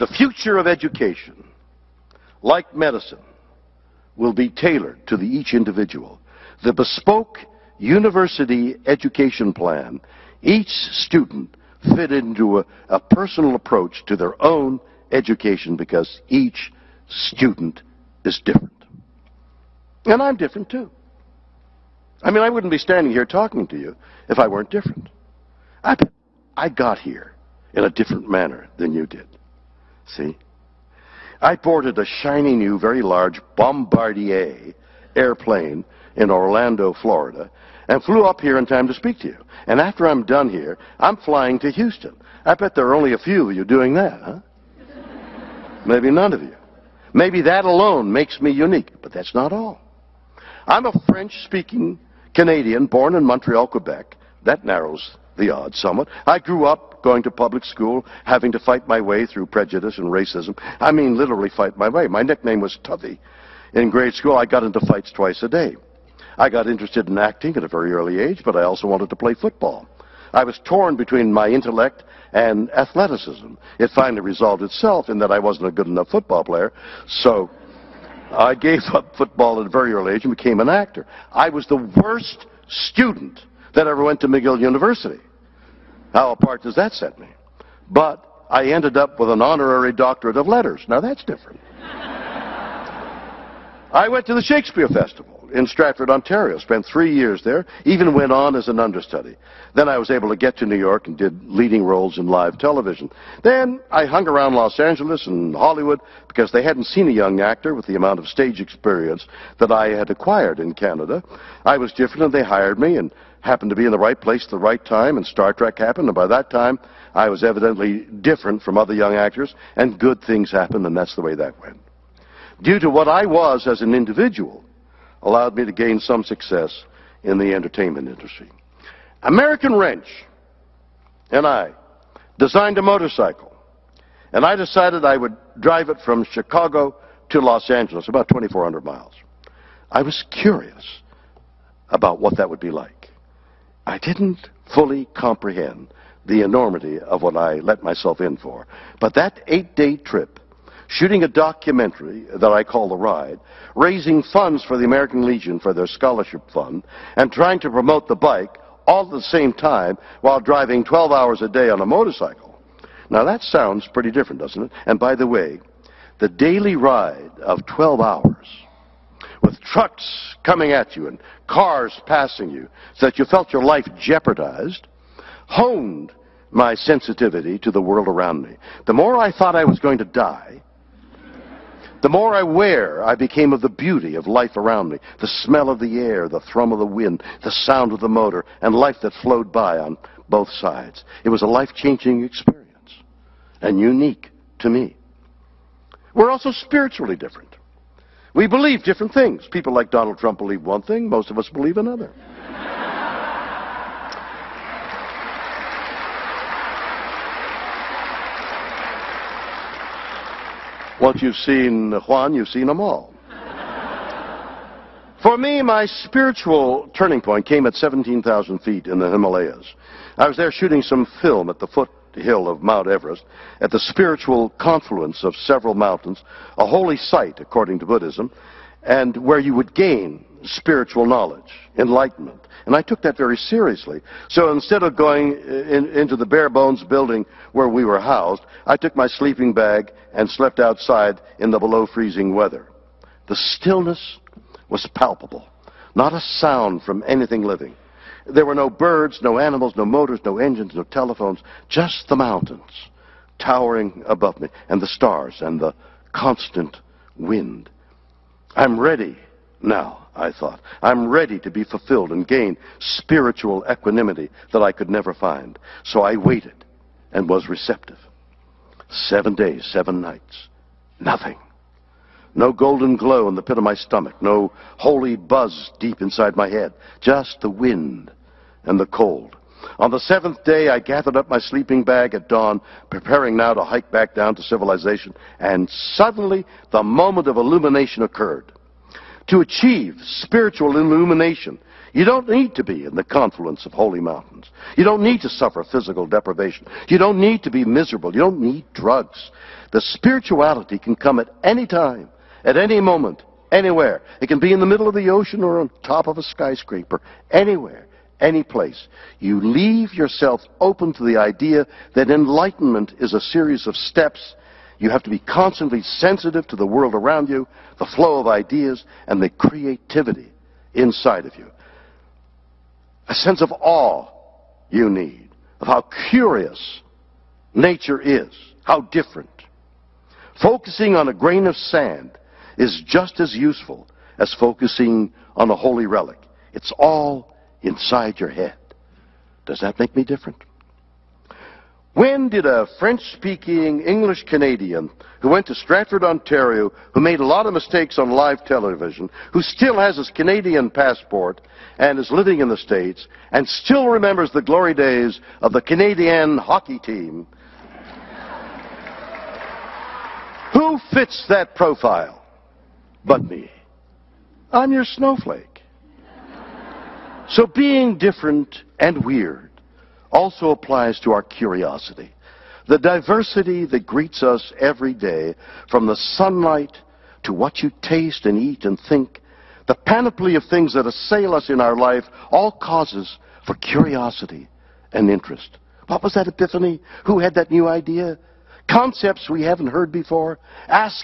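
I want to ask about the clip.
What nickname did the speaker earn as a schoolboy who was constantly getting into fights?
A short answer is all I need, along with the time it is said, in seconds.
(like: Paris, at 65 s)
Tuffy, at 62 s.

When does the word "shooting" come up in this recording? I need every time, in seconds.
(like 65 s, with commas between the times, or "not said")
150 s, 220 s.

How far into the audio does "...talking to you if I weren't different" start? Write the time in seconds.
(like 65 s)
23 s.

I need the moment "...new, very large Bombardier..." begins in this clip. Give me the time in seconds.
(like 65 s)
32 s.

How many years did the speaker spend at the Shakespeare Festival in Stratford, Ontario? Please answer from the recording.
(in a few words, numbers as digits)
3.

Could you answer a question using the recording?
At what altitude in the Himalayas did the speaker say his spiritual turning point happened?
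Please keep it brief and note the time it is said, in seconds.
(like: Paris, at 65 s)
17,000 feet, at 217 s.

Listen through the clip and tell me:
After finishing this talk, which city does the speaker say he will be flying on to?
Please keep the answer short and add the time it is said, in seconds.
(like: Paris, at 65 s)
Houston, at 41 s.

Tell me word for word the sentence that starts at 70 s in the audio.
I was torn between my intellect and athleticism.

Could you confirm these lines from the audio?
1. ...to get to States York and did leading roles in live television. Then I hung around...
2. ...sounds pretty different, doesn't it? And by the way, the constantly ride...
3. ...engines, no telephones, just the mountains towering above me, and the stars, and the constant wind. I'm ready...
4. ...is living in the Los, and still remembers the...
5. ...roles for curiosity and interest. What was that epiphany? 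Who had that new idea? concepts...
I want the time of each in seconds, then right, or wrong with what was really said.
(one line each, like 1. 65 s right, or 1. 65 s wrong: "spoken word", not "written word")
1. 100 s wrong: "New", not "States"
2. 163 s wrong: "daily", not "constantly"
3. 250 s right
4. 351 s wrong: "States", not "Los"
5. 382 s wrong: "causes", not "roles".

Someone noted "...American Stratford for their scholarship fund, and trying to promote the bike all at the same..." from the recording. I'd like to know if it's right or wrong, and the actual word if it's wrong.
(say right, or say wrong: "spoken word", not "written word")
wrong: "Legion", not "Stratford".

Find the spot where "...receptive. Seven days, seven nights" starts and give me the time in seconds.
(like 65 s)
267 s.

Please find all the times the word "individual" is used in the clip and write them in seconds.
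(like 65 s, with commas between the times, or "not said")
5 s, 123 s.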